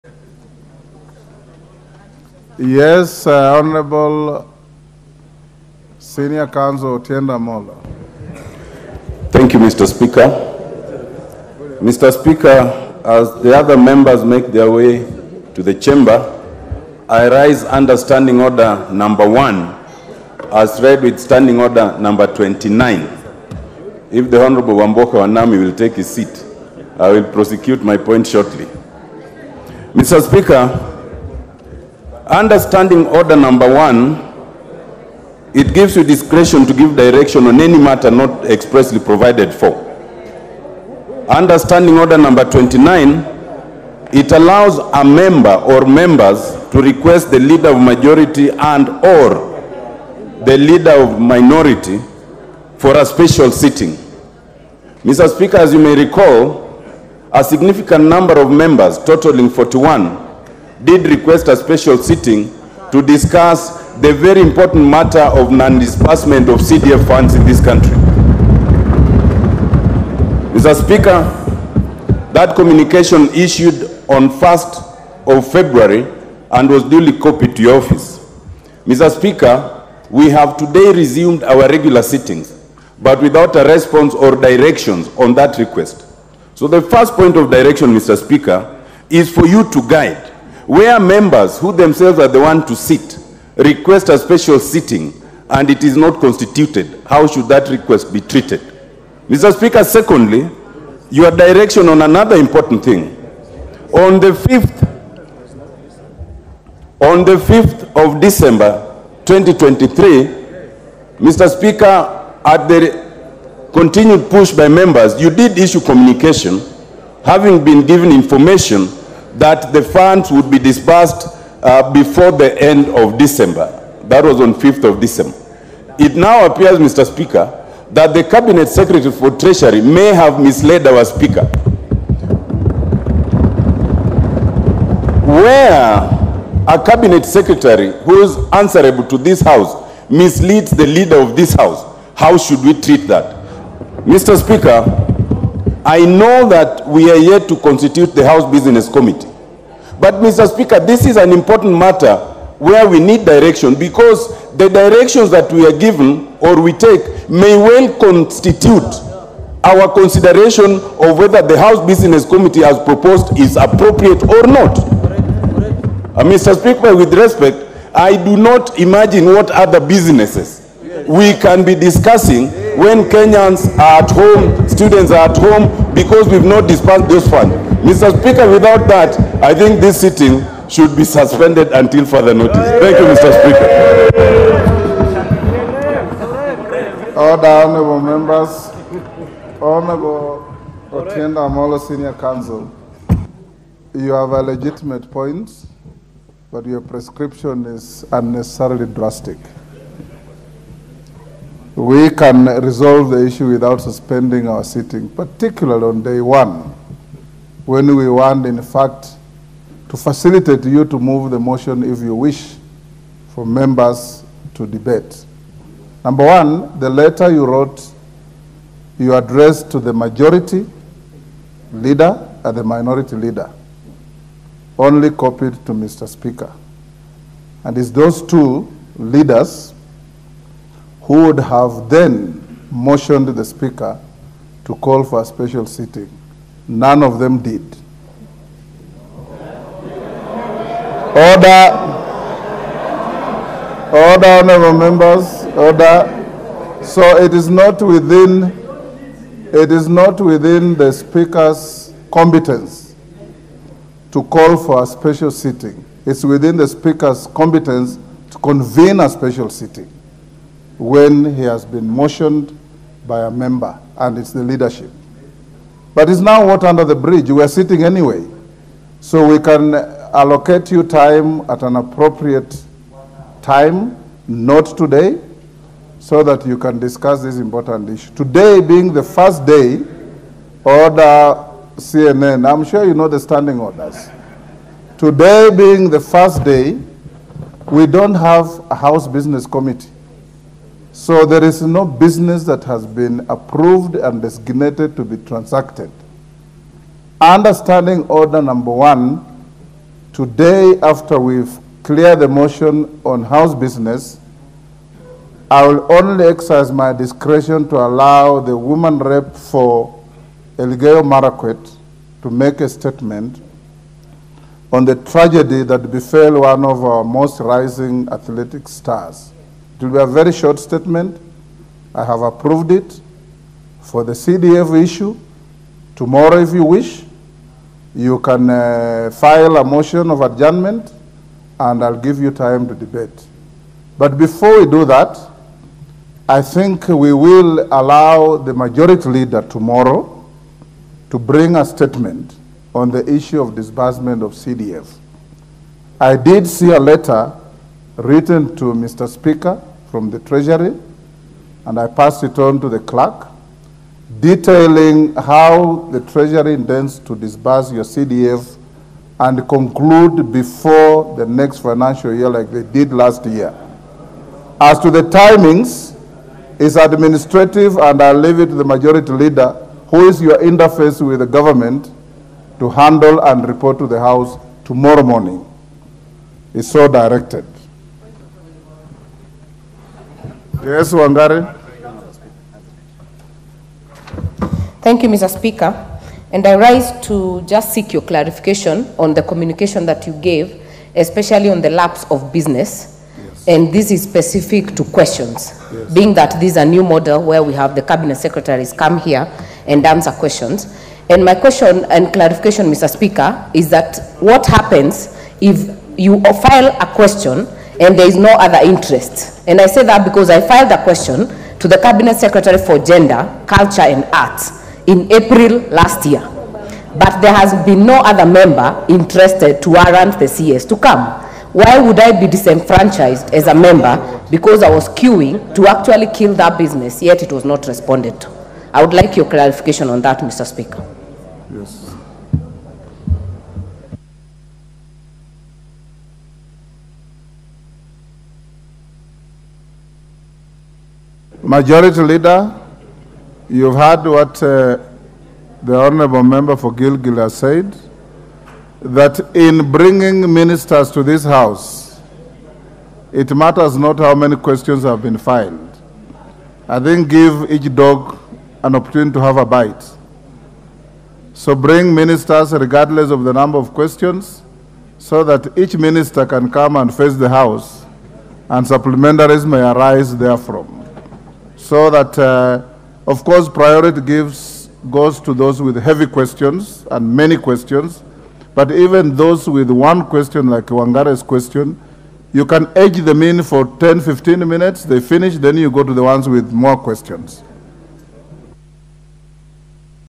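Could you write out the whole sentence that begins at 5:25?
Tomorrow, if you wish, you can uh, file a motion of adjournment and I'll give you time to debate.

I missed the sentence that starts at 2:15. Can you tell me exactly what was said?
Where a Cabinet Secretary who is answerable to this House misleads the leader of this House, how should we treat that?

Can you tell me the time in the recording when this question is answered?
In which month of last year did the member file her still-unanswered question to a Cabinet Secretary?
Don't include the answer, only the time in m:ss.
6:55.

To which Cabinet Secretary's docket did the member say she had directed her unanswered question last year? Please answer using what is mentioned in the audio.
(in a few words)
Gender, Culture and Arts.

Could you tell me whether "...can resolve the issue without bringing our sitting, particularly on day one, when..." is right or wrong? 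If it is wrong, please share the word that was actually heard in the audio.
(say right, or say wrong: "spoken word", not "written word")
wrong: "suspending", not "bringing".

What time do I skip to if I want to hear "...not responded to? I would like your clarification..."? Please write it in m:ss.
7:07.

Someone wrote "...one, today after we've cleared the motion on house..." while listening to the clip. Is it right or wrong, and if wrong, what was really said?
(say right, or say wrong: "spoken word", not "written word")
right.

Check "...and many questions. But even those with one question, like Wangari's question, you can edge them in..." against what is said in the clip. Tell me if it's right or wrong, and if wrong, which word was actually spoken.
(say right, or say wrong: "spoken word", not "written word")
right.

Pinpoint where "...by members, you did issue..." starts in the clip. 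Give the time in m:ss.
1:54.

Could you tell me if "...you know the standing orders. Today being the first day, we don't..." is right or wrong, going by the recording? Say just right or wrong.
right.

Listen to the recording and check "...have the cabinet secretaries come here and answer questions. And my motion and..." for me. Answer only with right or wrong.
wrong.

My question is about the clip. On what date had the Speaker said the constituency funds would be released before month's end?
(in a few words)
5th of December 2023.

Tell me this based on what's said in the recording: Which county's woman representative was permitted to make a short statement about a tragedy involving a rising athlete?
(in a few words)
Elgeyo Marakwet.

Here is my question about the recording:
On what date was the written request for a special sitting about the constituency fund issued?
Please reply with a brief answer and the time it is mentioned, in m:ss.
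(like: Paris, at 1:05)
1st of February, at 1:14.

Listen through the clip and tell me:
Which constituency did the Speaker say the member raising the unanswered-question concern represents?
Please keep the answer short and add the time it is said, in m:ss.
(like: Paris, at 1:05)
Gilgil, at 7:26.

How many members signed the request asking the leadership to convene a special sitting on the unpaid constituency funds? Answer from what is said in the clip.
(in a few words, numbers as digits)
41.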